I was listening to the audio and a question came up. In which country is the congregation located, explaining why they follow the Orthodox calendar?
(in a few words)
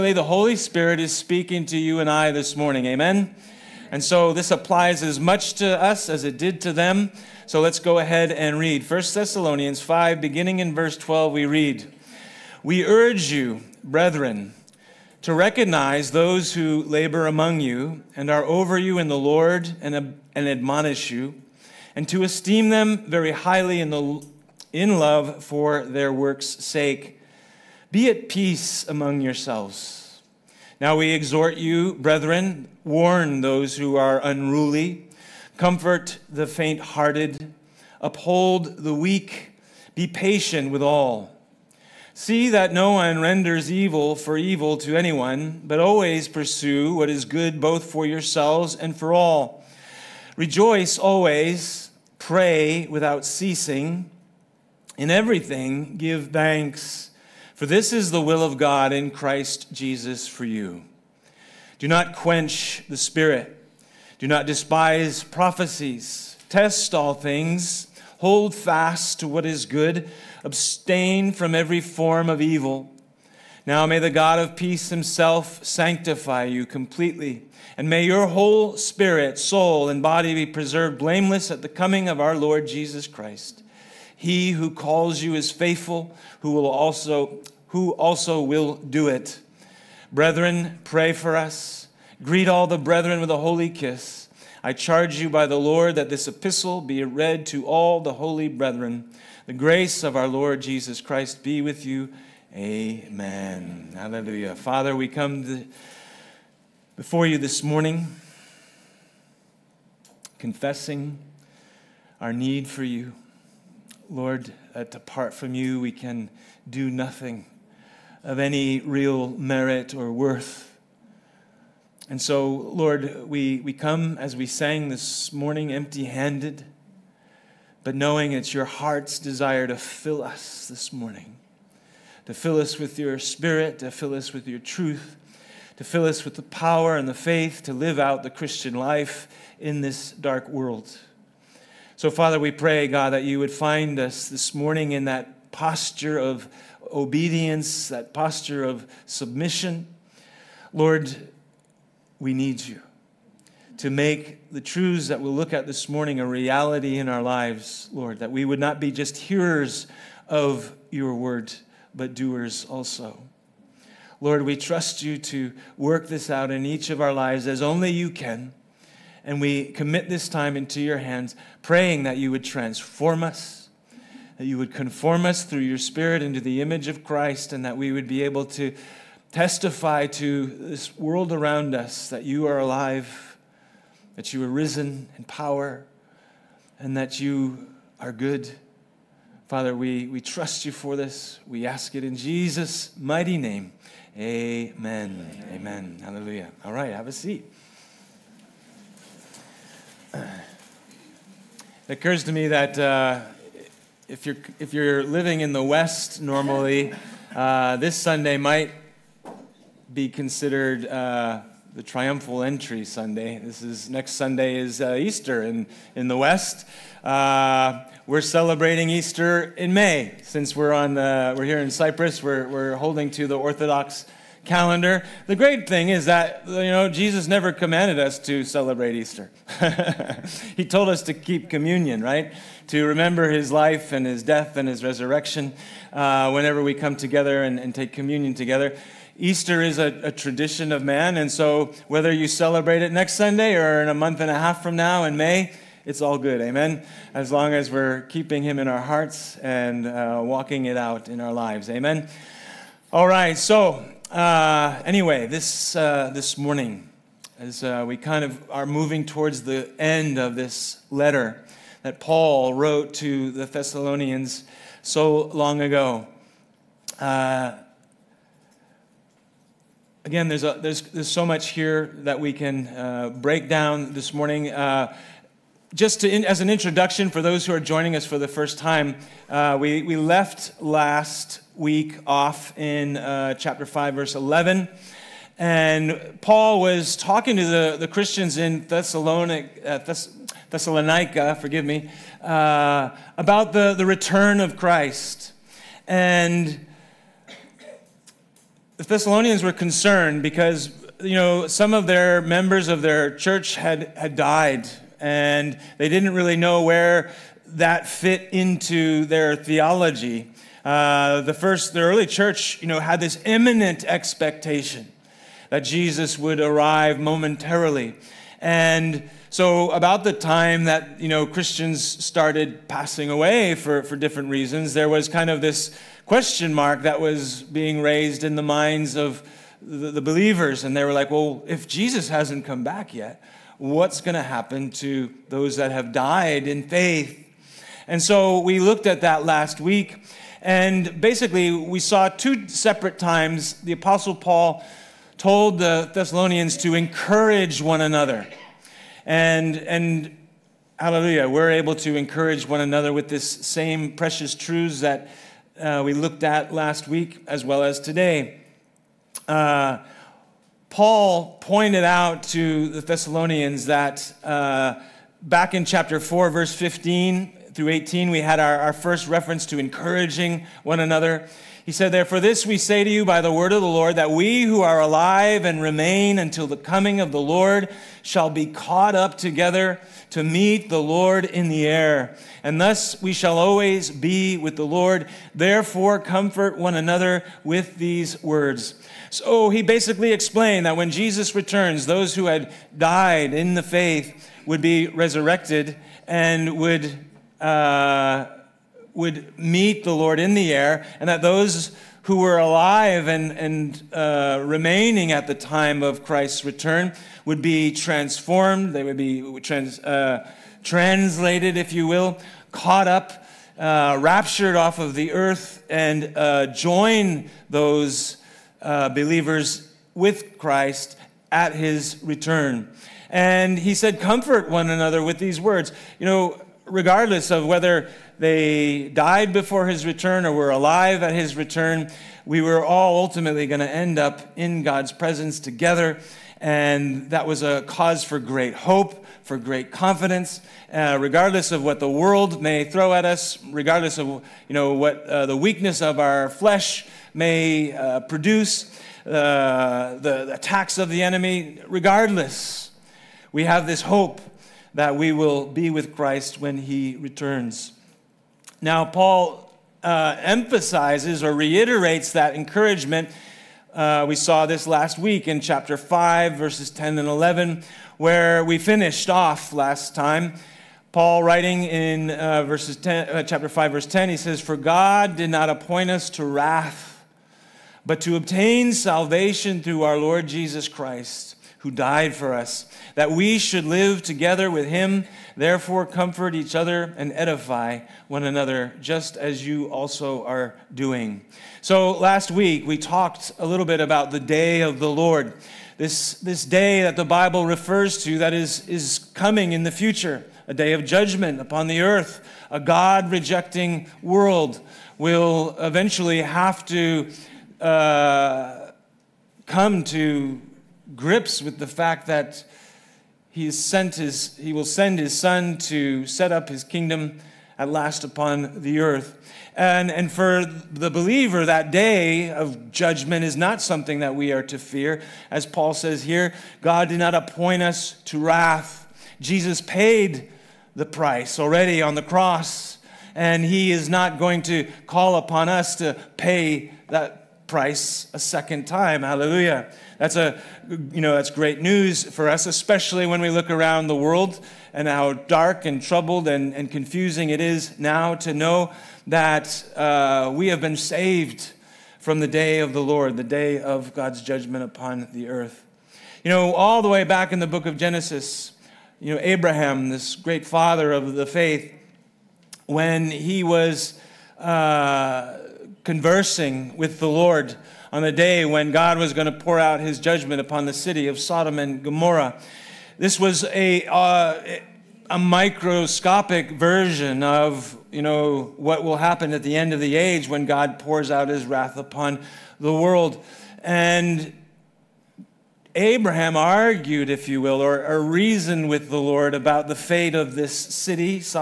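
Cyprus.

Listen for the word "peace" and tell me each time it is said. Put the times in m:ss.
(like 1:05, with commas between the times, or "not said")
0:28, 1:14.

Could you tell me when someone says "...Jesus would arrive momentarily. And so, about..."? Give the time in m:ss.
5:15.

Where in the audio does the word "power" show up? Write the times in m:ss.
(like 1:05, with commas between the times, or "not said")
2:16, 3:05.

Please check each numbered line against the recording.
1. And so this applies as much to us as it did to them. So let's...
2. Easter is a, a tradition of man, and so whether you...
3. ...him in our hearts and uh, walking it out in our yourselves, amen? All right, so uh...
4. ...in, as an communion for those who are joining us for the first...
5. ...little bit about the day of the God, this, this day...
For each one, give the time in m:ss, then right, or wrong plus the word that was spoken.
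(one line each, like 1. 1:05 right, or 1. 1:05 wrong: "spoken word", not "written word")
1. 0:03 right
2. 3:59 right
3. 4:08 wrong: "lives", not "yourselves"
4. 4:36 wrong: "introduction", not "communion"
5. 8:13 wrong: "Lord", not "God".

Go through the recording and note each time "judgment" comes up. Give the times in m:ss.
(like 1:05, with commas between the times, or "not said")
8:20, 8:42, 9:14, 9:29.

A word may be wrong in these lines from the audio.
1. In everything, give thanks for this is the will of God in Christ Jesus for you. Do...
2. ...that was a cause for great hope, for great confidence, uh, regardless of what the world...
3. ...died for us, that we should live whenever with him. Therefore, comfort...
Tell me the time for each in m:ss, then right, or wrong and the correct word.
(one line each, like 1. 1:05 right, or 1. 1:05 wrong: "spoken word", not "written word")
1. 0:54 right
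2. 7:17 right
3. 8:01 wrong: "together", not "whenever".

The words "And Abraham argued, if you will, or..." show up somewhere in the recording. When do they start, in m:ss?
9:43.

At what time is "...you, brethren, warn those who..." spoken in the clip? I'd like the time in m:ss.
0:31.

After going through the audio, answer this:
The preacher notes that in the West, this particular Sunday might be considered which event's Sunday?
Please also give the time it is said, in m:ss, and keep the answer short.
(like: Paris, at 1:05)
The triumphal entry, at 3:31.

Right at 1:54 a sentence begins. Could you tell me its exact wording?
Lord, uh, that apart from you we can do nothing of any real merit or worth.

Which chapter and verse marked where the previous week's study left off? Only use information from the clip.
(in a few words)
Chapter 5, verse 11.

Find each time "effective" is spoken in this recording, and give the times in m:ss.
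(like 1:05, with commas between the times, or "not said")
not said.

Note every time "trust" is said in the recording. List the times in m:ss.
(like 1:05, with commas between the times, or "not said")
2:44, 3:10.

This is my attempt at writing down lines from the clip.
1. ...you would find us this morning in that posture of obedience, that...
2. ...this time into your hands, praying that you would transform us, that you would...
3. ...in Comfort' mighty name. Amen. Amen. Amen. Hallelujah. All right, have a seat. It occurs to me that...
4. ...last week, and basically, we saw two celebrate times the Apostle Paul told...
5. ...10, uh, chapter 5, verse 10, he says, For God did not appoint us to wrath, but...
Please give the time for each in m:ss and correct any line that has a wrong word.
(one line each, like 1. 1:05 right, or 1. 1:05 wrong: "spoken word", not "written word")
1. 2:23 right
2. 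2:50 right
3. 3:12 wrong: "Jesus", not "Comfort"
4. 5:39 wrong: "separate", not "celebrate"
5. 7:52 right.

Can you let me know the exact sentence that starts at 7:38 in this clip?
Now, Paul uh, emphasizes or reiterates that encouragement.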